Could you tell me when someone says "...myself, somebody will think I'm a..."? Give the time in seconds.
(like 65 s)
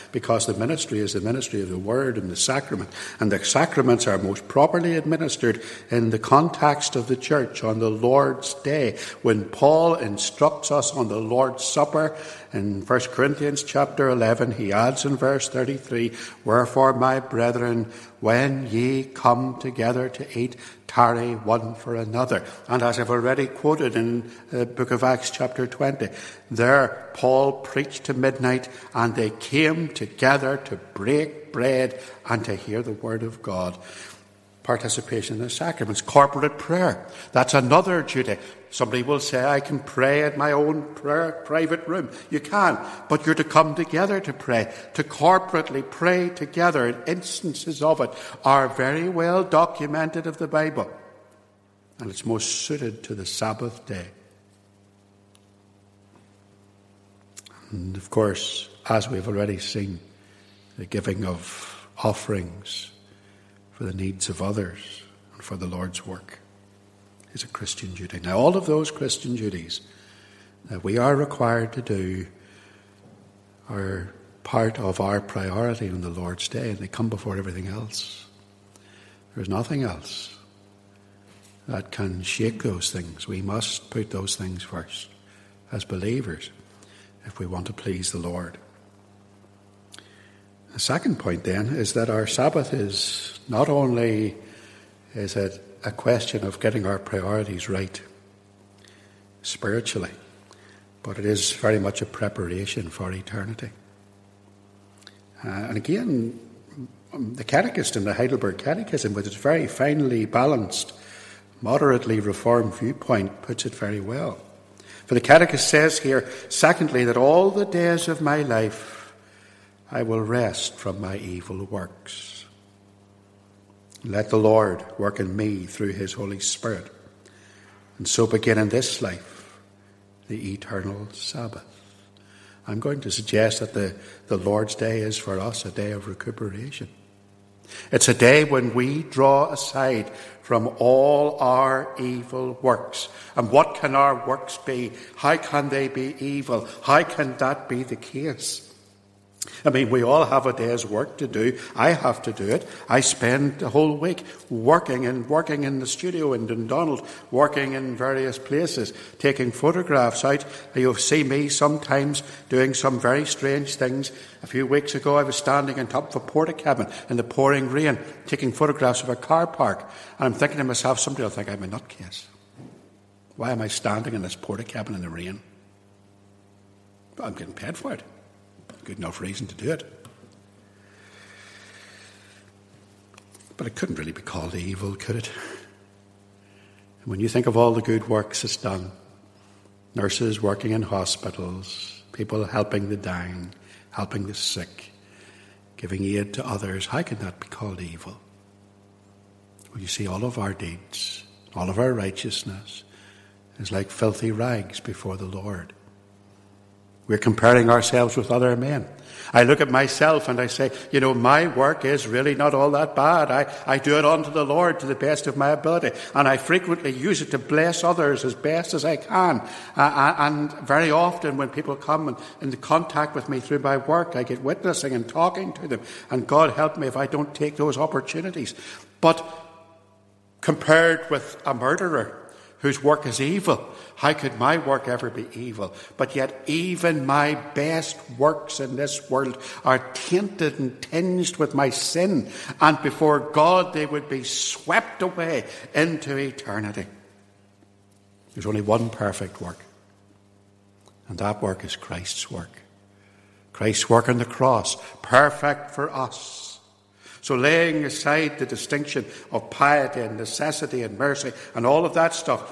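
170 s.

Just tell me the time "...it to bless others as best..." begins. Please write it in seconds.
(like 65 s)
217 s.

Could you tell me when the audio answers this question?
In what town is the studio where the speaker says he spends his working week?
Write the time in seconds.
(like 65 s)
156 s.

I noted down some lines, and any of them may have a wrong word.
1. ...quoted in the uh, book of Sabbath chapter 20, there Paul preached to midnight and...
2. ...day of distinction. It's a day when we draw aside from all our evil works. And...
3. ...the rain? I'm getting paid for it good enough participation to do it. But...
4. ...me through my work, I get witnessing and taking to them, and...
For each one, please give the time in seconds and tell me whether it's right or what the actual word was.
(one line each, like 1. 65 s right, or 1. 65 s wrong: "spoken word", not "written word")
1. 23 s wrong: "Acts", not "Sabbath"
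2. 135 s wrong: "recuperation", not "distinction"
3. 175 s wrong: "reason", not "participation"
4. 223 s wrong: "talking", not "taking".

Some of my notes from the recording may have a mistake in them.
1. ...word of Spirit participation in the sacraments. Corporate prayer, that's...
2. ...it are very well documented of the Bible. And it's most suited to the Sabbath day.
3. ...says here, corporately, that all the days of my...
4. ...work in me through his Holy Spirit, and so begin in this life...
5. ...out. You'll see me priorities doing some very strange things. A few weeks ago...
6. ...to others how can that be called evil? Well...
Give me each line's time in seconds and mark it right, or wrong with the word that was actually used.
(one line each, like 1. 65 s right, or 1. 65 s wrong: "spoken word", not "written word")
1. 32 s wrong: "God", not "Spirit"
2. 47 s right
3. 115 s wrong: "secondly", not "corporately"
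4. 124 s right
5. 160 s wrong: "sometimes", not "priorities"
6. 196 s right.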